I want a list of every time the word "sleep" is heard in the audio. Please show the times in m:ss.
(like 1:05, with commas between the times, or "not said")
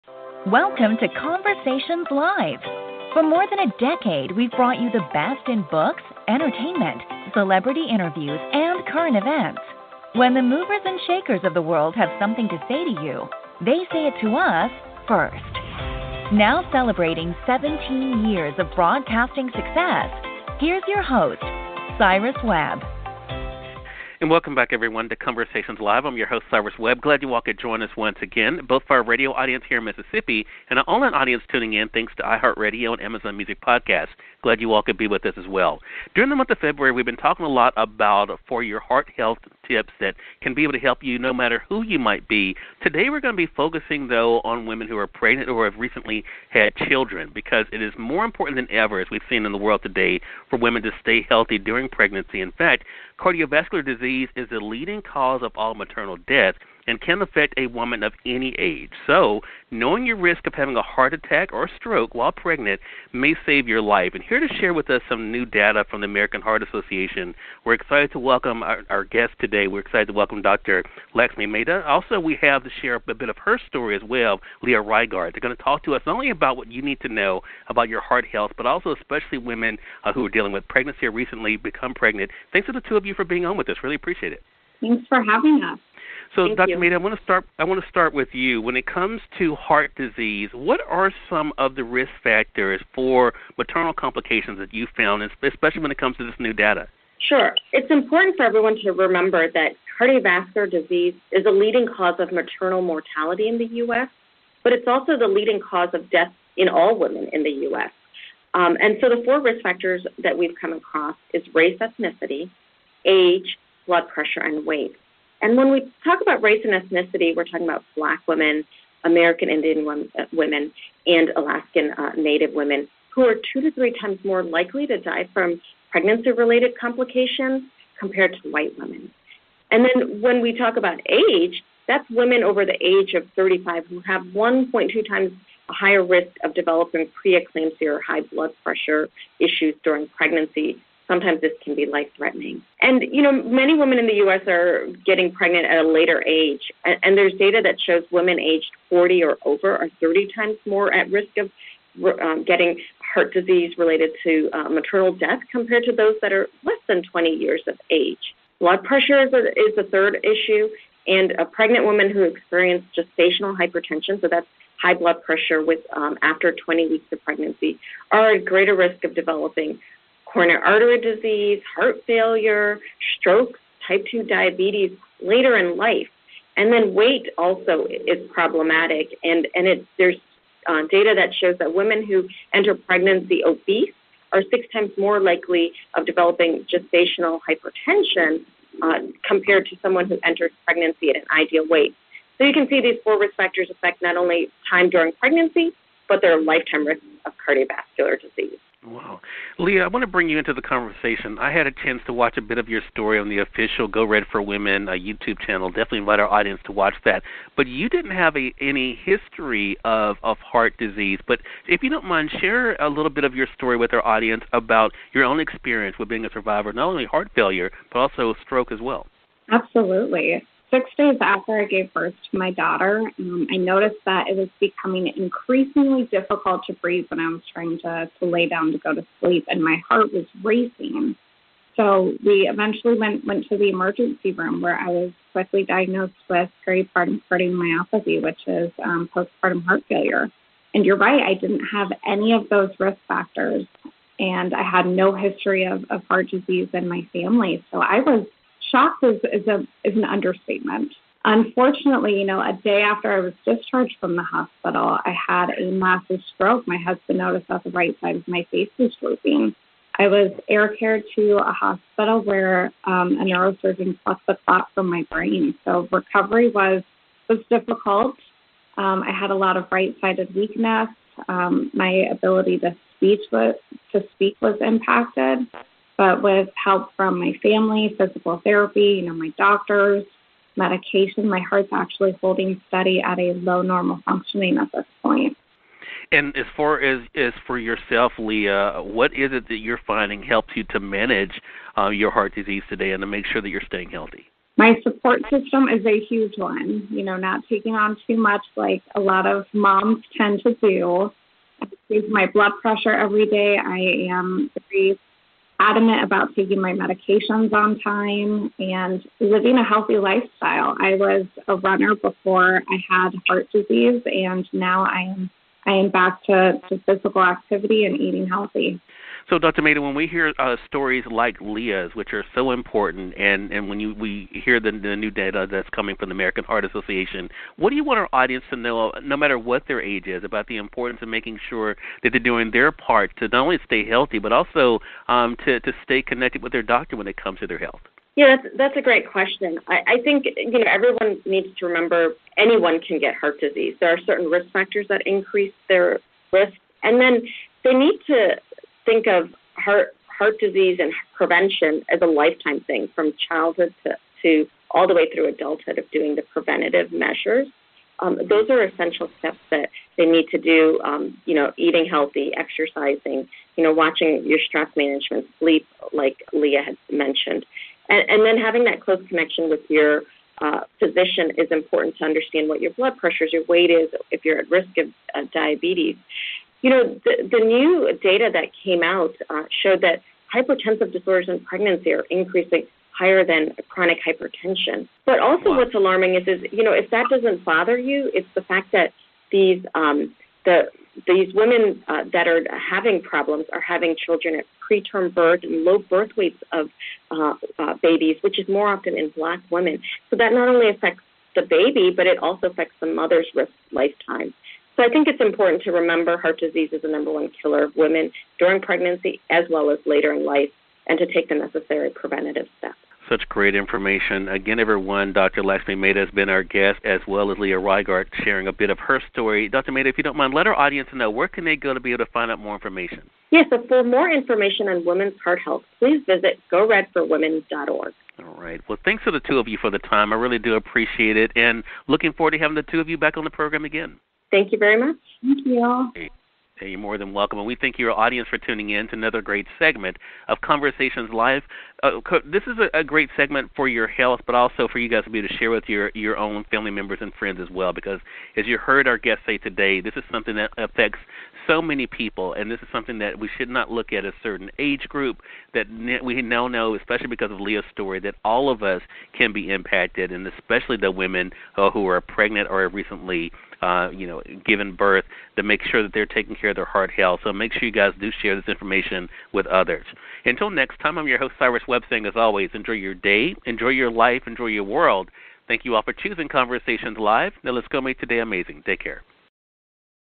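3:49, 6:05.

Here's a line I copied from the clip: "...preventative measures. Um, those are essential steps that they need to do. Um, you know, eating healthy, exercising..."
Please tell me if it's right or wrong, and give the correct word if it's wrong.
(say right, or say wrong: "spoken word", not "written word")
right.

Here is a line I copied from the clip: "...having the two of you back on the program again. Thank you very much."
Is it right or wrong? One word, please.
right.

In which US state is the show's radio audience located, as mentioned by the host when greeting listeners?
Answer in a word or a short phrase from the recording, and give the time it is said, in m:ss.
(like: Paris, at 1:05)
Mississippi, at 0:29.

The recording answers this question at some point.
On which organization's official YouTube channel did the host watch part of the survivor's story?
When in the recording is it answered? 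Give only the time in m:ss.
3:23.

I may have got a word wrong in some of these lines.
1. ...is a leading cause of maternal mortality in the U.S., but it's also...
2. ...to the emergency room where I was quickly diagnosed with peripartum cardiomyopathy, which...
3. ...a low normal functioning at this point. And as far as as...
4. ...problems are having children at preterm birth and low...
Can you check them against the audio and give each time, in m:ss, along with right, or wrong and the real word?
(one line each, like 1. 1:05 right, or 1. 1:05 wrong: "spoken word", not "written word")
1. 1:41 right
2. 3:53 right
3. 4:43 right
4. 6:33 right.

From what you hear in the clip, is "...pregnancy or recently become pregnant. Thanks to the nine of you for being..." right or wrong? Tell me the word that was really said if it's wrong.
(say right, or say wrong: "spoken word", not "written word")
wrong: "two", not "nine".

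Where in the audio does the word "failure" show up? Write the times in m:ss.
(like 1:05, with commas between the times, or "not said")
2:52, 3:37, 3:59.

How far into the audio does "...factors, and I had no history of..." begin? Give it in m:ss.
4:03.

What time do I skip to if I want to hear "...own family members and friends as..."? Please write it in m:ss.
7:26.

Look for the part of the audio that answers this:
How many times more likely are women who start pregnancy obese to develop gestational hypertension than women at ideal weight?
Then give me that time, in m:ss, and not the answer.
3:04.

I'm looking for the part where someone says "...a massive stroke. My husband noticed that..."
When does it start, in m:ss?
4:15.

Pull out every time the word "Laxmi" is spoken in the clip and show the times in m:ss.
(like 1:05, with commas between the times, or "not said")
1:11, 6:55.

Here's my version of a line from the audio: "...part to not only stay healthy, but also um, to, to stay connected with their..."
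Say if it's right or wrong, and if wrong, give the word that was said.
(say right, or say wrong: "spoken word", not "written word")
right.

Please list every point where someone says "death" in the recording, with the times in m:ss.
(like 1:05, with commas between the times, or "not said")
0:56, 1:46, 2:35.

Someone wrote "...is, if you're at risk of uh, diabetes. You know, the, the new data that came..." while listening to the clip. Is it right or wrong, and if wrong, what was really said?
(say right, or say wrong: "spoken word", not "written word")
right.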